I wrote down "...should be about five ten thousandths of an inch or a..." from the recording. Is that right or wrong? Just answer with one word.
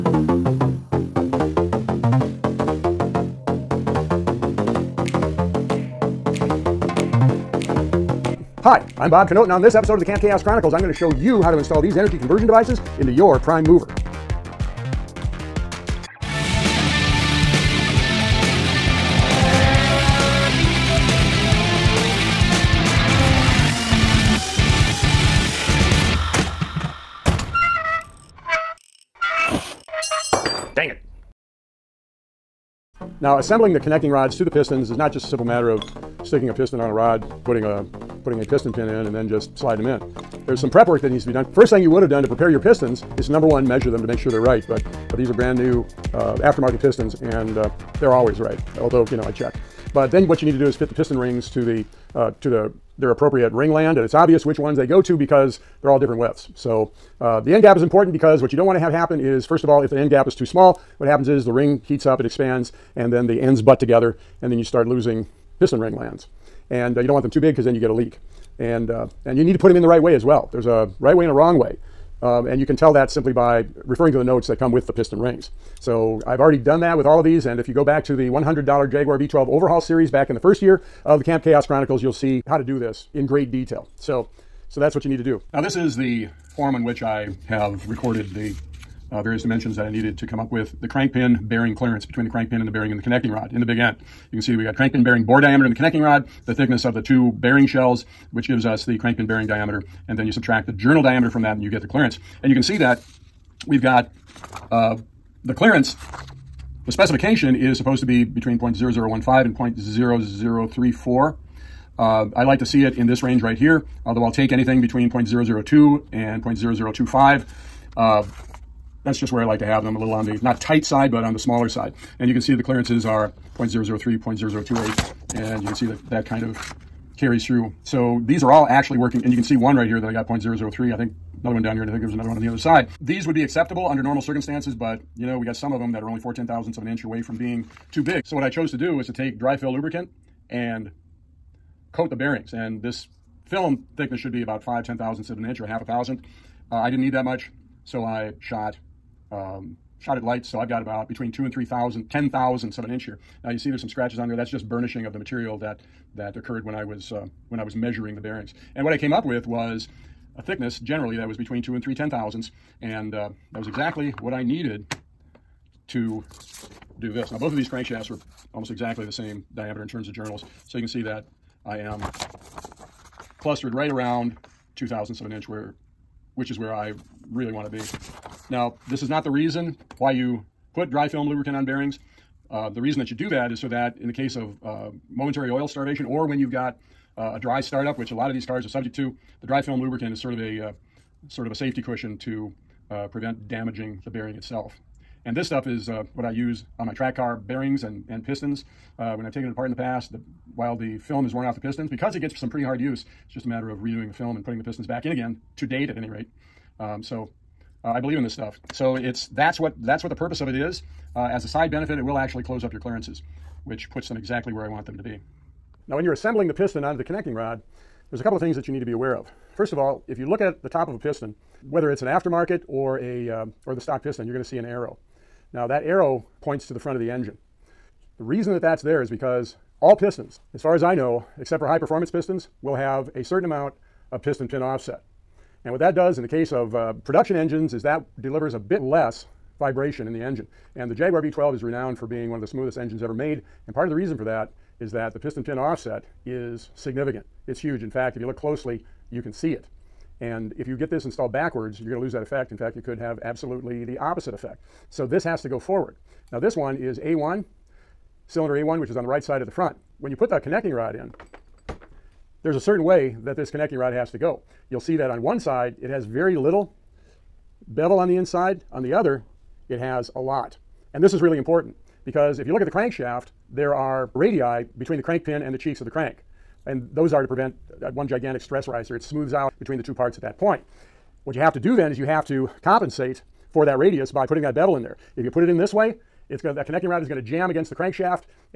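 right.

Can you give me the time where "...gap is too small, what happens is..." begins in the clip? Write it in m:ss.
1:00.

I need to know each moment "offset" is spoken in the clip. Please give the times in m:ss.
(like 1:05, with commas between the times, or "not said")
3:54, 4:05.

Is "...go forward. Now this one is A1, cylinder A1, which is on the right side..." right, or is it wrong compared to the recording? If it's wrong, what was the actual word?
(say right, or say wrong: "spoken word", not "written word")
right.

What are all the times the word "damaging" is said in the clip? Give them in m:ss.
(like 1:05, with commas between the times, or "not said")
3:13.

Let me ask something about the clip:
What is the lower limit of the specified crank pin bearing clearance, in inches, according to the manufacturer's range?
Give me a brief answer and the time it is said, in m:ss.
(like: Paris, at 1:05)
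0.0015, at 1:48.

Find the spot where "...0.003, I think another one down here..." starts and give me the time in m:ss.
2:10.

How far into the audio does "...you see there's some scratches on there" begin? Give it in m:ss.
2:33.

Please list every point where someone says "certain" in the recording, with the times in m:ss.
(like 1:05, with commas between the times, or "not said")
3:53, 4:22.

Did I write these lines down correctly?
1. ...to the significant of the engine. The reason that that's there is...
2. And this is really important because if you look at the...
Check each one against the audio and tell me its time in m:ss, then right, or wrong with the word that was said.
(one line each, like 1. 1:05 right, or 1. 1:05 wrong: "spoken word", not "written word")
1. 3:46 wrong: "front", not "significant"
2. 4:30 right.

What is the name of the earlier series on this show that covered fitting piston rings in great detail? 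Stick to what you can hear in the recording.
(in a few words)
$100 Jaguar V12 overhaul.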